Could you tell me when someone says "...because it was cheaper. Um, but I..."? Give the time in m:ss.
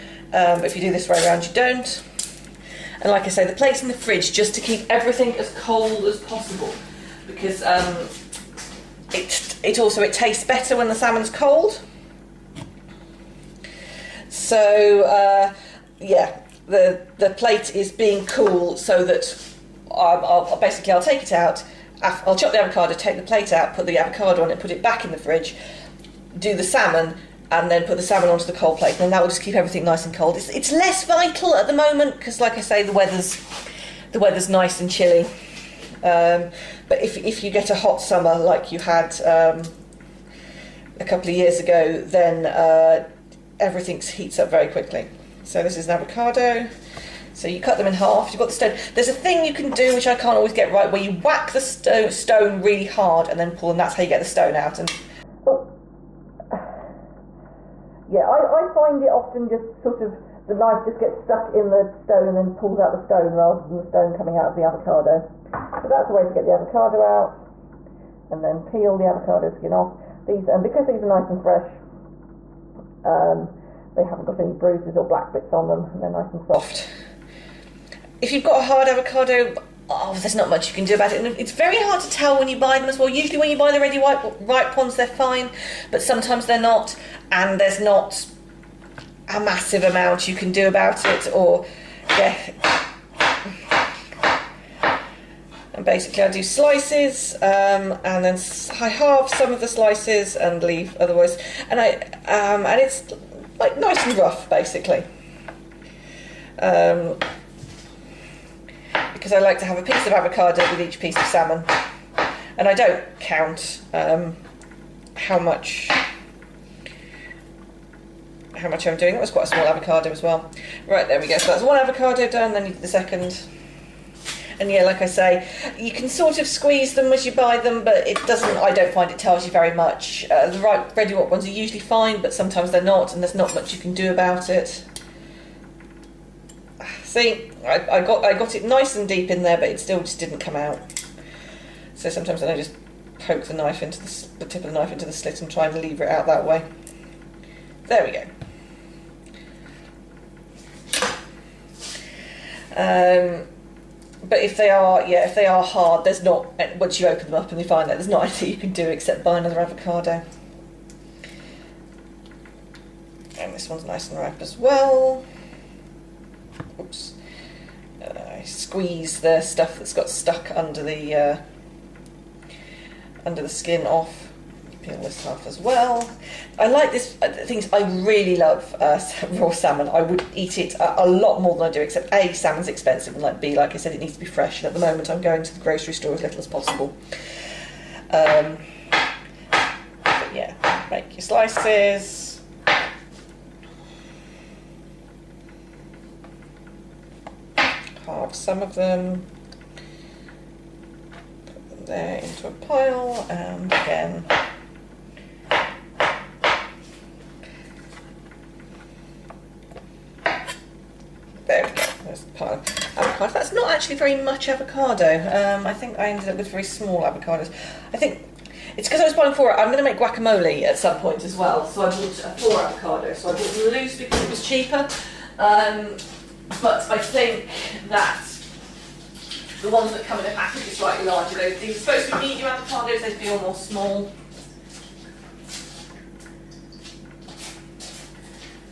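3:43.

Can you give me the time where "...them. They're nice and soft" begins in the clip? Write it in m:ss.
1:15.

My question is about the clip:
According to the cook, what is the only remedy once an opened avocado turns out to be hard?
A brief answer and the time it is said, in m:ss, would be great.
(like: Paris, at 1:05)
Buy another avocado, at 2:39.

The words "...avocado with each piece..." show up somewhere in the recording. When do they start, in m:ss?
1:50.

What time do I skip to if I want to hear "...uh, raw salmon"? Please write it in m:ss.
2:58.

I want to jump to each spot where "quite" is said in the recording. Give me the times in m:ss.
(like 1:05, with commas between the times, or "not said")
1:59.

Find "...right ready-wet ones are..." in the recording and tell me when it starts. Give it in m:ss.
2:10.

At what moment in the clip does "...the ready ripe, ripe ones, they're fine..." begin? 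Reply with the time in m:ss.
1:23.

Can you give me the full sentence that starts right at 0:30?
It's, it's less vital at the moment because, like I say, the weather's the weather's nice and chilly.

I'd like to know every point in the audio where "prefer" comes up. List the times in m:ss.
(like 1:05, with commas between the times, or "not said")
not said.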